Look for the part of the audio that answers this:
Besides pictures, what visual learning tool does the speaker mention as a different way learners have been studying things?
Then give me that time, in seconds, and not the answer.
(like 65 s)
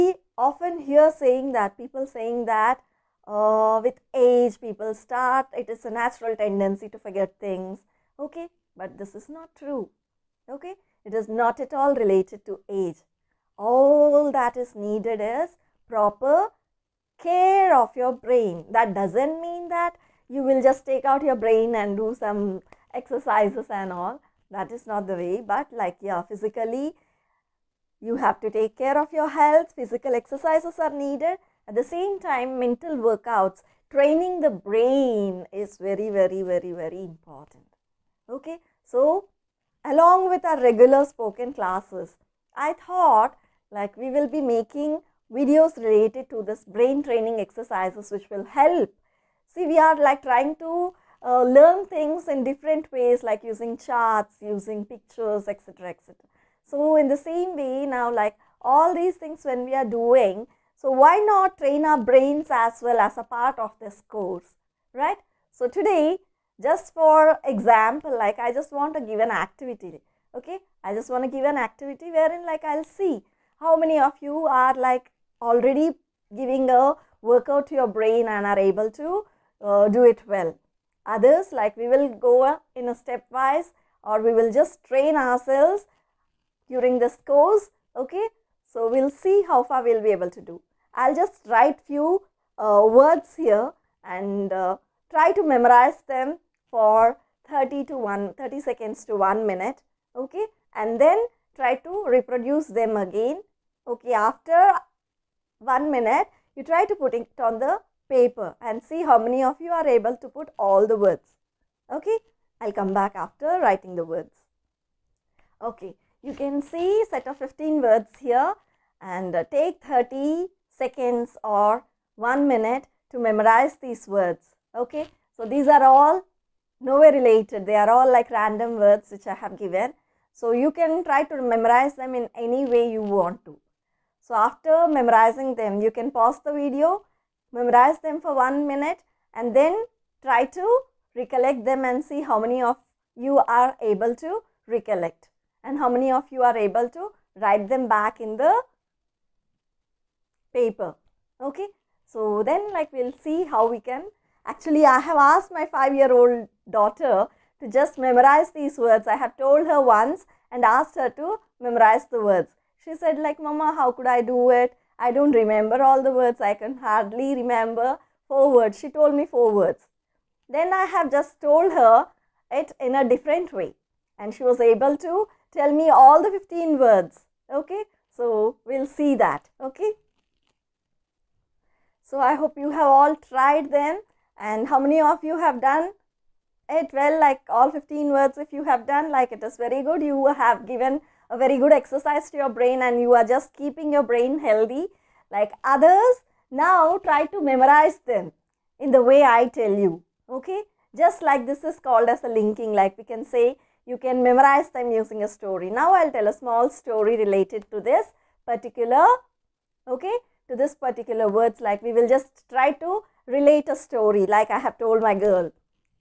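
53 s.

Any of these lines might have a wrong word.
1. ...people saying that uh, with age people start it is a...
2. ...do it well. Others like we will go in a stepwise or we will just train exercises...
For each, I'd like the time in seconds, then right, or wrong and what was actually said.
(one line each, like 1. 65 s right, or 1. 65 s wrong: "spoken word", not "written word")
1. 1 s right
2. 79 s wrong: "ourselves", not "exercises".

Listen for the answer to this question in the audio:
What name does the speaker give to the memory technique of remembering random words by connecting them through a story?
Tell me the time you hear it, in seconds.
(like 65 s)
202 s.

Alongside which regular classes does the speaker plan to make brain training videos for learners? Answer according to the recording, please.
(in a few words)
Spoken classes.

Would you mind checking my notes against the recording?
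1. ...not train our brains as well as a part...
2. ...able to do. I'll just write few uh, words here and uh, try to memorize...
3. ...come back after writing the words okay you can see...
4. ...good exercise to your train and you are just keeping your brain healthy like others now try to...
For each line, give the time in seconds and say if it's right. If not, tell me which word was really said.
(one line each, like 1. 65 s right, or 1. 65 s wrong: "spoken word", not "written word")
1. 61 s right
2. 90 s right
3. 112 s right
4. 191 s wrong: "brain", not "train".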